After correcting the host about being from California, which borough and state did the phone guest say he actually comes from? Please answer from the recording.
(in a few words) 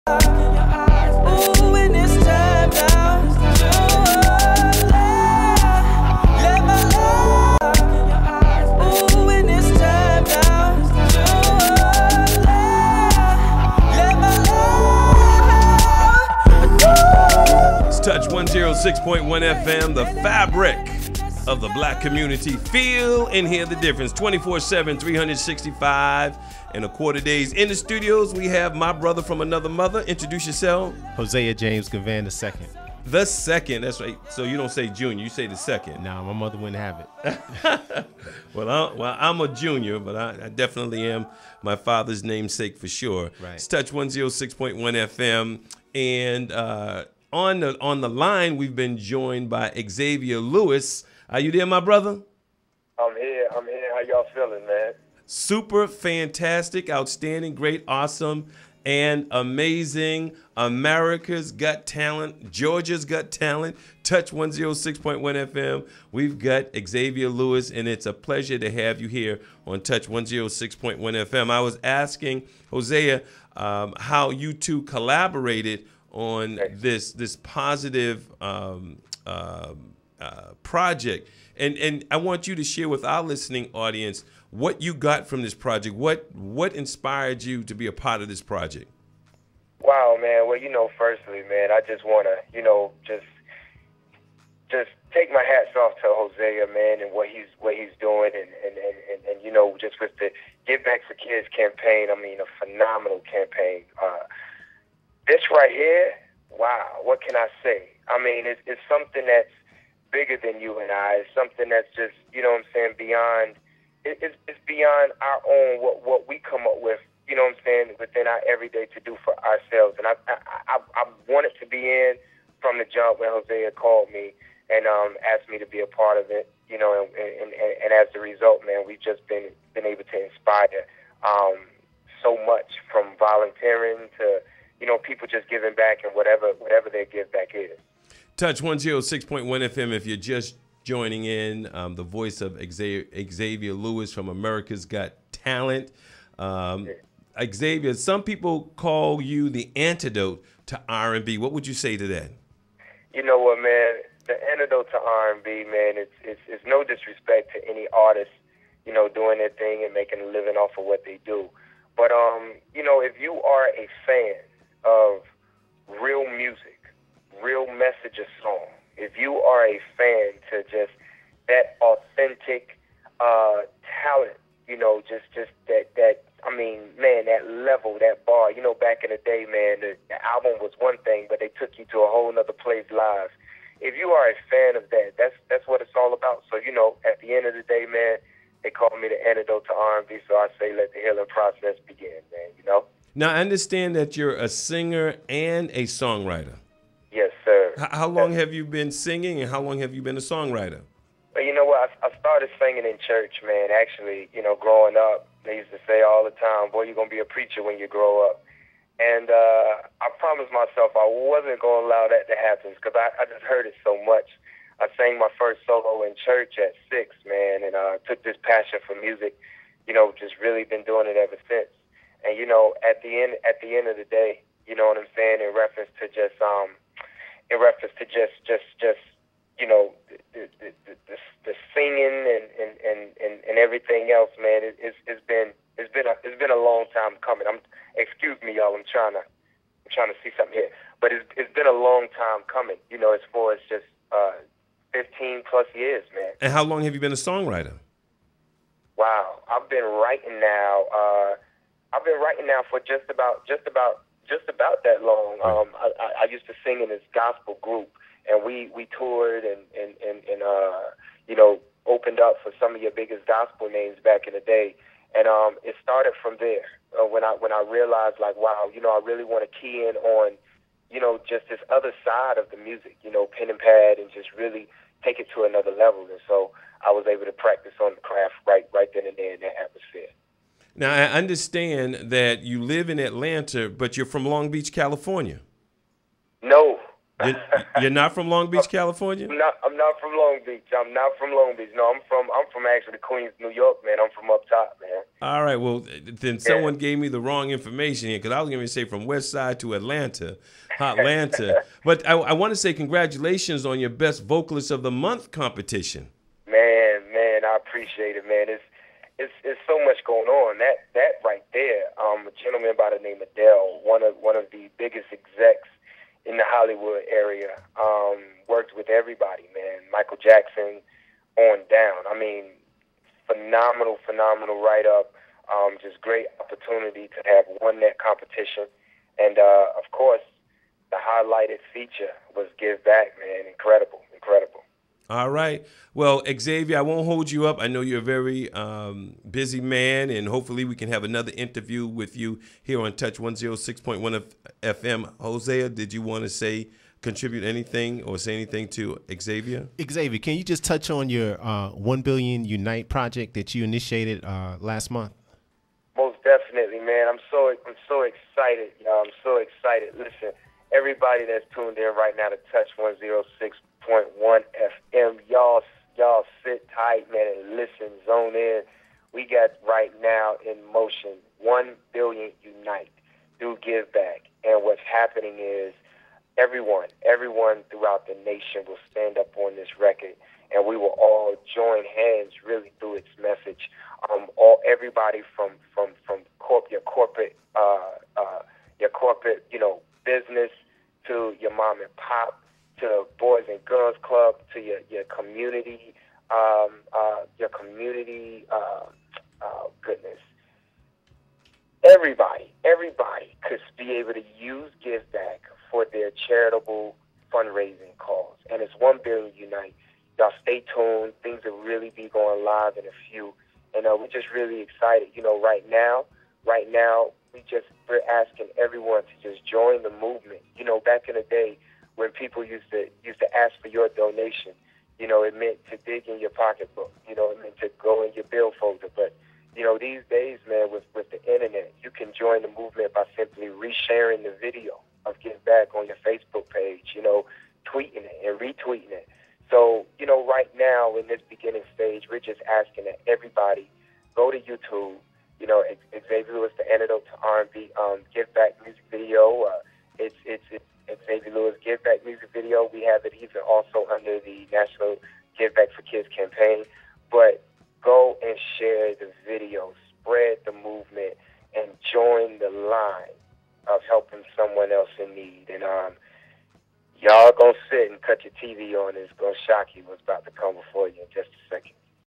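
Queens, New York.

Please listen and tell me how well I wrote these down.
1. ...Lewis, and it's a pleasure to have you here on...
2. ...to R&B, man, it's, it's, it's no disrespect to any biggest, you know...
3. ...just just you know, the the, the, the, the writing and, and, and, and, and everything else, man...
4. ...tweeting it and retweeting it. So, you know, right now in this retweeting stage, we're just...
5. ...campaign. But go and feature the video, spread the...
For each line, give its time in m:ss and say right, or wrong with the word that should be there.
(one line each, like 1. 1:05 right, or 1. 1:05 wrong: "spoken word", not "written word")
1. 1:07 right
2. 2:34 wrong: "artist", not "biggest"
3. 3:48 wrong: "singing", not "writing"
4. 7:17 wrong: "beginning", not "retweeting"
5. 7:36 wrong: "share", not "feature".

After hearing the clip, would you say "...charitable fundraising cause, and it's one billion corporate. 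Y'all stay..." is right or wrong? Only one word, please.
wrong.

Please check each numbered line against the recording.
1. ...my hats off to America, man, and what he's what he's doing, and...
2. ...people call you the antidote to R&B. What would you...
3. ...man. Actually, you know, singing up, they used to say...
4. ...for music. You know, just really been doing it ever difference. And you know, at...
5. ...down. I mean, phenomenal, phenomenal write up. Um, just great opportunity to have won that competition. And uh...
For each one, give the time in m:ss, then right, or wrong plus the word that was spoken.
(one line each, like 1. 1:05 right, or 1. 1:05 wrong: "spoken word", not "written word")
1. 1:35 wrong: "Hosea", not "America"
2. 2:28 right
3. 3:23 wrong: "growing", not "singing"
4. 3:38 wrong: "since", not "difference"
5. 5:21 right.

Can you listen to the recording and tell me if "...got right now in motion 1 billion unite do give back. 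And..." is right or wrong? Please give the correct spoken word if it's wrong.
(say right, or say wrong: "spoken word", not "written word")
right.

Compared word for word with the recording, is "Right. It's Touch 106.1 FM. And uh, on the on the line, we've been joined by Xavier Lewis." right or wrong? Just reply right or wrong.
right.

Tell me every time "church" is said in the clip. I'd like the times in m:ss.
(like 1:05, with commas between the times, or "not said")
3:23, 3:36.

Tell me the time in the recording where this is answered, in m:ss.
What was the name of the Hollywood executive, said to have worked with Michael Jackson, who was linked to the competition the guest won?
5:13.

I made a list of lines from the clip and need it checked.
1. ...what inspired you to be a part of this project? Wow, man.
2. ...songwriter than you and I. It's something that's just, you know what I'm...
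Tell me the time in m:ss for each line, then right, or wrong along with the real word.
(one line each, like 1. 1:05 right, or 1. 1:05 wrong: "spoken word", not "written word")
1. 1:26 right
2. 1:50 wrong: "bigger", not "songwriter".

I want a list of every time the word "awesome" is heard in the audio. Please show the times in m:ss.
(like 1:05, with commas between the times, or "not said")
0:57.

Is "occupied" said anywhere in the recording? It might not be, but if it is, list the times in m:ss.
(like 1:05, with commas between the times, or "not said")
not said.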